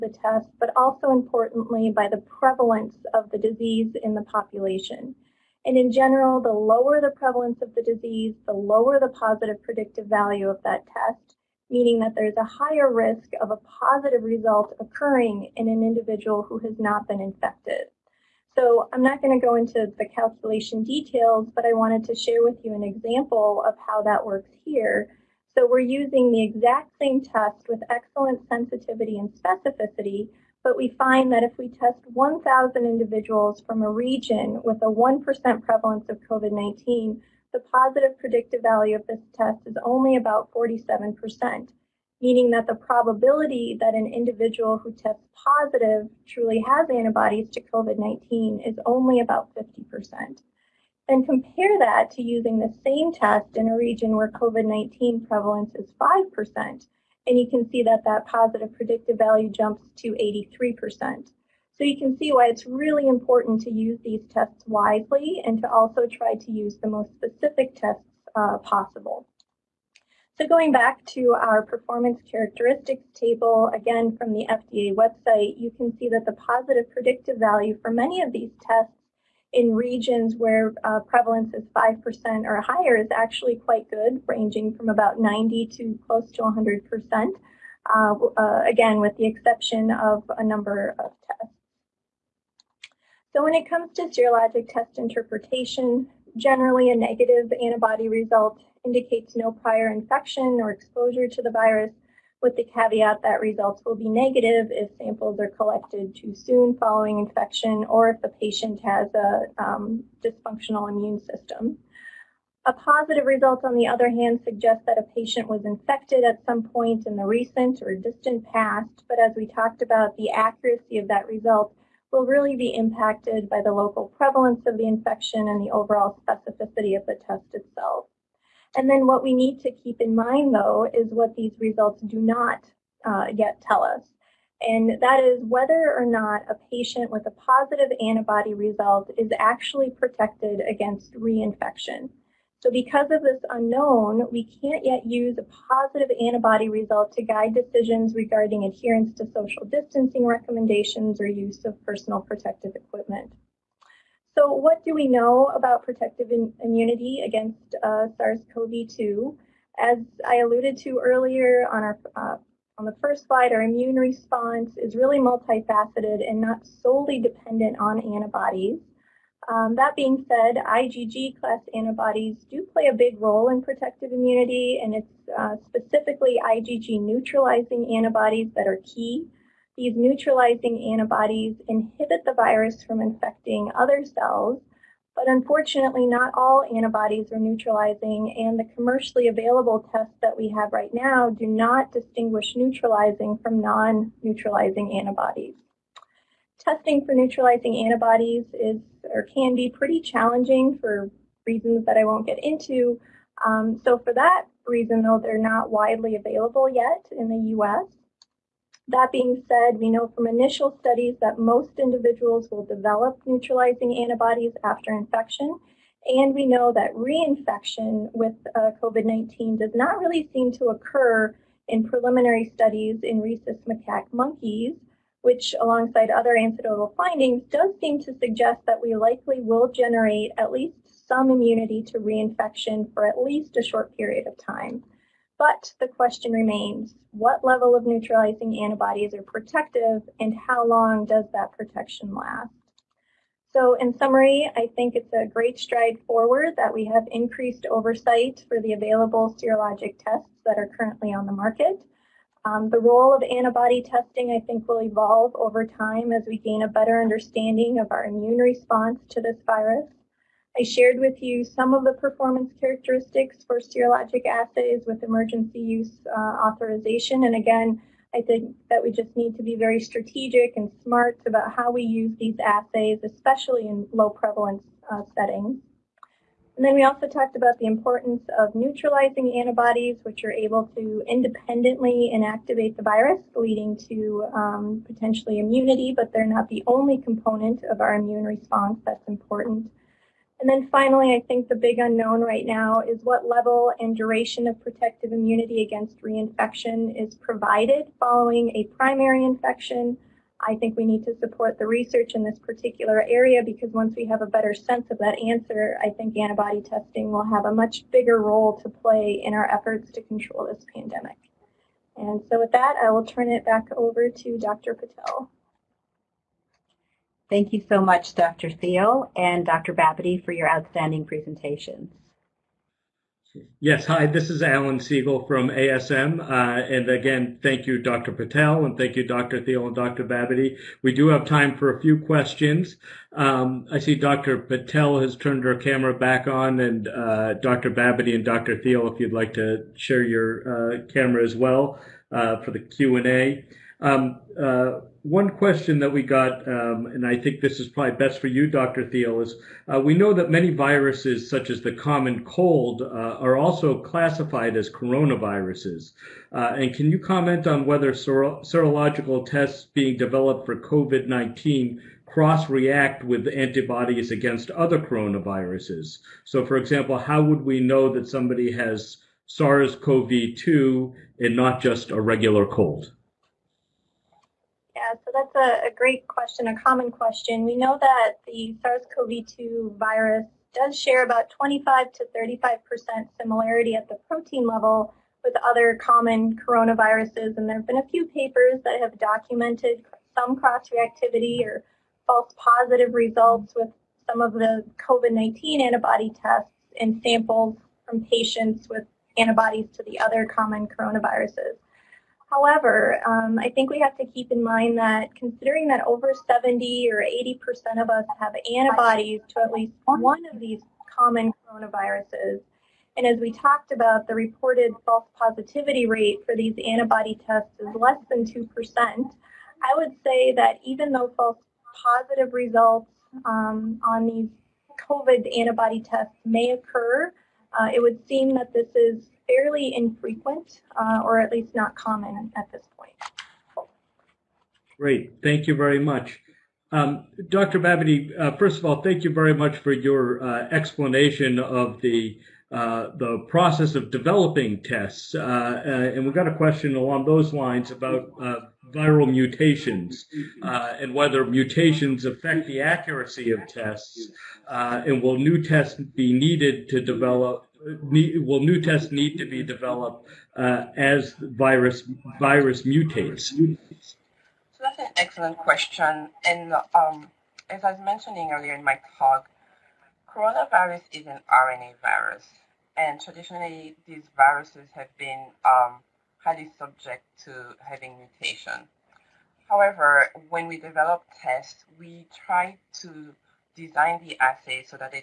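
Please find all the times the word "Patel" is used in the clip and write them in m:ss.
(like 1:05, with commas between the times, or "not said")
5:14, 5:28, 5:34.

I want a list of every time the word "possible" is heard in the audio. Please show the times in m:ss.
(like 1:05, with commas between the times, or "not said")
1:08.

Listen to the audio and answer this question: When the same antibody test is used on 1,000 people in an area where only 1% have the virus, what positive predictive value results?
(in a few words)
47%.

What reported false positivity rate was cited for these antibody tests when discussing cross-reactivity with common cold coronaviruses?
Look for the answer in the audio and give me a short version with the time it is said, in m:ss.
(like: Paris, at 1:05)
Less than 2%, at 6:57.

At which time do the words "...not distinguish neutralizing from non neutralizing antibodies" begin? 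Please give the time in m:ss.
3:11.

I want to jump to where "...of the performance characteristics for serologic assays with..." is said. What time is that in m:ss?
4:21.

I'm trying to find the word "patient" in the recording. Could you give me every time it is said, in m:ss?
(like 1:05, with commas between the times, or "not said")
1:48, 1:55, 2:16, 6:38.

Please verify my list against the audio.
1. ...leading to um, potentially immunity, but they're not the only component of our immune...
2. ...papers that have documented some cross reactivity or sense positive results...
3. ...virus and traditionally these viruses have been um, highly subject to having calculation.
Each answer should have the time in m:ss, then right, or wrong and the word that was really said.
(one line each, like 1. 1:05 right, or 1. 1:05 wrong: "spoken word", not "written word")
1. 4:43 right
2. 6:28 wrong: "false", not "sense"
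3. 7:51 wrong: "mutation", not "calculation".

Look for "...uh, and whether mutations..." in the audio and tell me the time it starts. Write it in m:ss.
7:30.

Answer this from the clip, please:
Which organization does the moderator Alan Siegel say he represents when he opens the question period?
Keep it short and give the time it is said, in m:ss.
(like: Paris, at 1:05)
ASM, at 5:25.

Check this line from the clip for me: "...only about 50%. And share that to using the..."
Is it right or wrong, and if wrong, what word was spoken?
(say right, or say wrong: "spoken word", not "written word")
wrong: "compare", not "share".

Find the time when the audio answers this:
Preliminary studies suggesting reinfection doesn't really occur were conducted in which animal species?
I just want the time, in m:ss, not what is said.
3:43.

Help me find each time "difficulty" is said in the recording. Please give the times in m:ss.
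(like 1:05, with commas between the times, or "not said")
not said.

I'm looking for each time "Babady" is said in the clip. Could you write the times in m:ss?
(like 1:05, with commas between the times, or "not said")
5:19, 5:30, 5:37, 7:17.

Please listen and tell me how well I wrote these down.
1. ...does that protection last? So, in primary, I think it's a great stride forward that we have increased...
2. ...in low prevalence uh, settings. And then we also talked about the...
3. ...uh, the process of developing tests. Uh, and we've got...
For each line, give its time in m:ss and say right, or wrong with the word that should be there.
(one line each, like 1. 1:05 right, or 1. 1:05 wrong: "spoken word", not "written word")
1. 4:01 wrong: "summary", not "primary"
2. 4:33 right
3. 7:22 right.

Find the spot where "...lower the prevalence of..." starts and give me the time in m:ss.
0:06.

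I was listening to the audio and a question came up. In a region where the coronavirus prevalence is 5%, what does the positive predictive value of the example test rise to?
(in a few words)
83%.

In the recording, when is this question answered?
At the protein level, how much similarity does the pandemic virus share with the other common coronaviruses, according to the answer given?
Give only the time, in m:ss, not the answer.
6:21.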